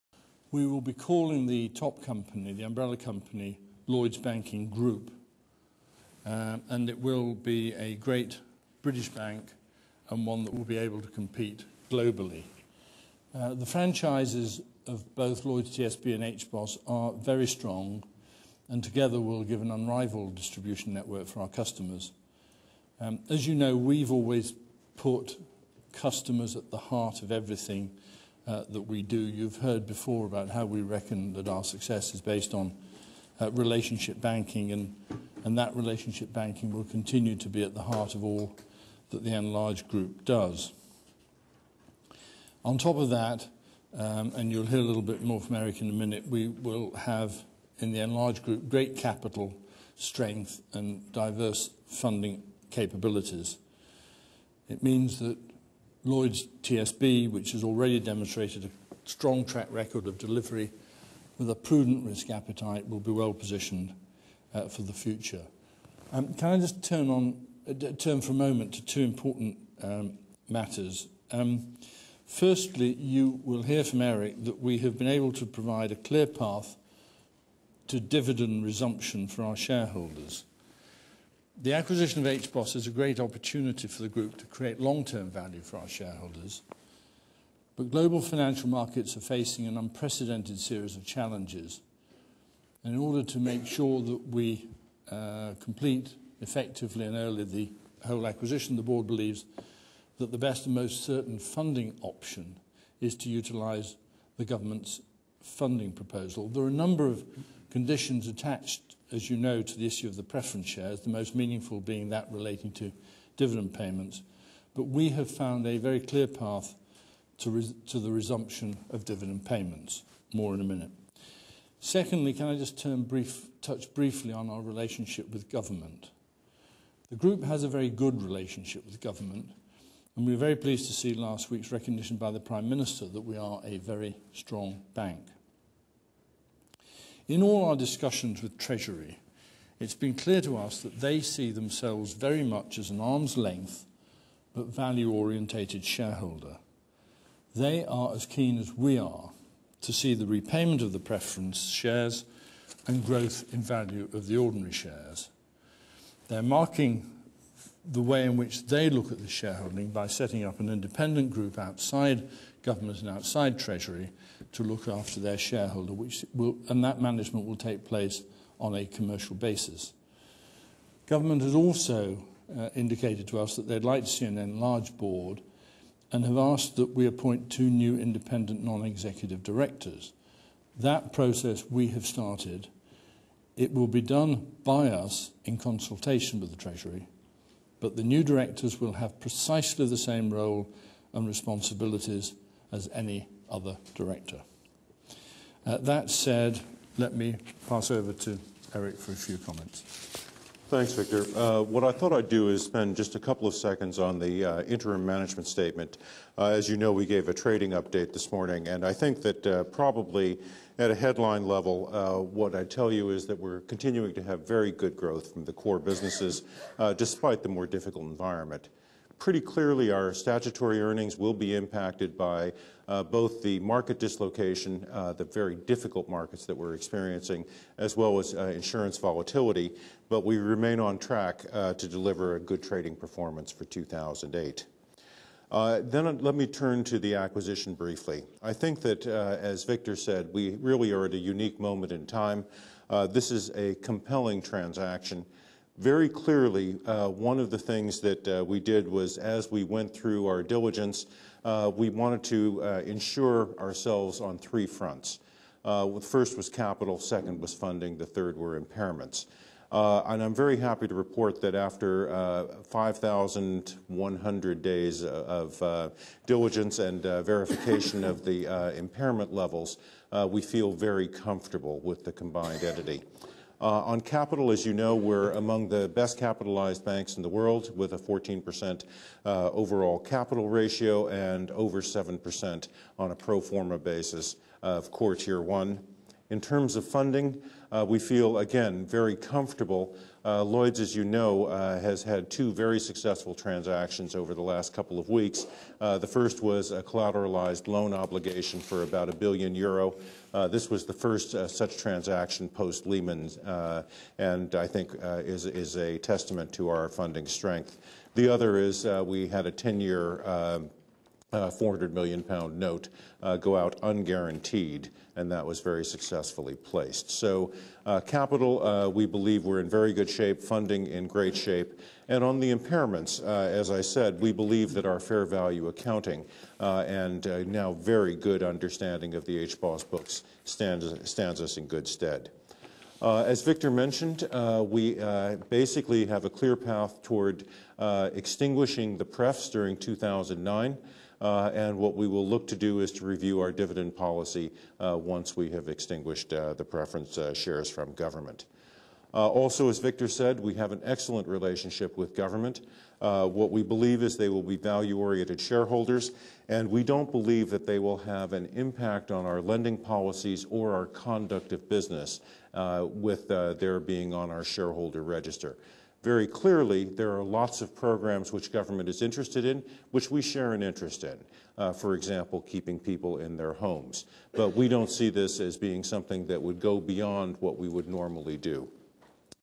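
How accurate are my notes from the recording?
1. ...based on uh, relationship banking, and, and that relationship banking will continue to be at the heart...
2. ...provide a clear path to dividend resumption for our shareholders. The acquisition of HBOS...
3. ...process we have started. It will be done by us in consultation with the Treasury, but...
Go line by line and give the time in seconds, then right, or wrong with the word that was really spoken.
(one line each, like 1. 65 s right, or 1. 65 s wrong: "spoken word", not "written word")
1. 32 s right
2. 75 s right
3. 181 s right.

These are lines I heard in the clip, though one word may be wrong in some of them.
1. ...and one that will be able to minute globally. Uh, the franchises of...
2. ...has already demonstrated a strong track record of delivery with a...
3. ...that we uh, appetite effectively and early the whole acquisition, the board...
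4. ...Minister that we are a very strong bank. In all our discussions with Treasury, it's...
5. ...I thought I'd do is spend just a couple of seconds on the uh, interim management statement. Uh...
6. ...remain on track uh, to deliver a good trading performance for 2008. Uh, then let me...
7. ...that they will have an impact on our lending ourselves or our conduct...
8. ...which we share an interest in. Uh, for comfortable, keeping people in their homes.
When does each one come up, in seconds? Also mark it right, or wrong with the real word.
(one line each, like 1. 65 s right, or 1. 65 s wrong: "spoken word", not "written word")
1. 10 s wrong: "compete", not "minute"
2. 57 s right
3. 94 s wrong: "complete", not "appetite"
4. 132 s right
5. 201 s right
6. 230 s right
7. 357 s wrong: "policies", not "ourselves"
8. 369 s wrong: "example", not "comfortable".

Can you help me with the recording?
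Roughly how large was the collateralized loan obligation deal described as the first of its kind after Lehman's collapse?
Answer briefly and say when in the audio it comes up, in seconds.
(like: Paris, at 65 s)
1 billion euro, at 299 s.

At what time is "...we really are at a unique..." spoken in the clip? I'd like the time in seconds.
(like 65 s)
240 s.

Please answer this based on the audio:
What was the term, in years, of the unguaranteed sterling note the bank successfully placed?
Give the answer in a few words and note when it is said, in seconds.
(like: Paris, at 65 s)
10 years, at 309 s.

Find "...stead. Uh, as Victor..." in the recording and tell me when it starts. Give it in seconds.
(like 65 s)
331 s.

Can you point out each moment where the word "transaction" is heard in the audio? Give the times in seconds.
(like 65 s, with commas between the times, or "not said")
244 s, 293 s, 301 s.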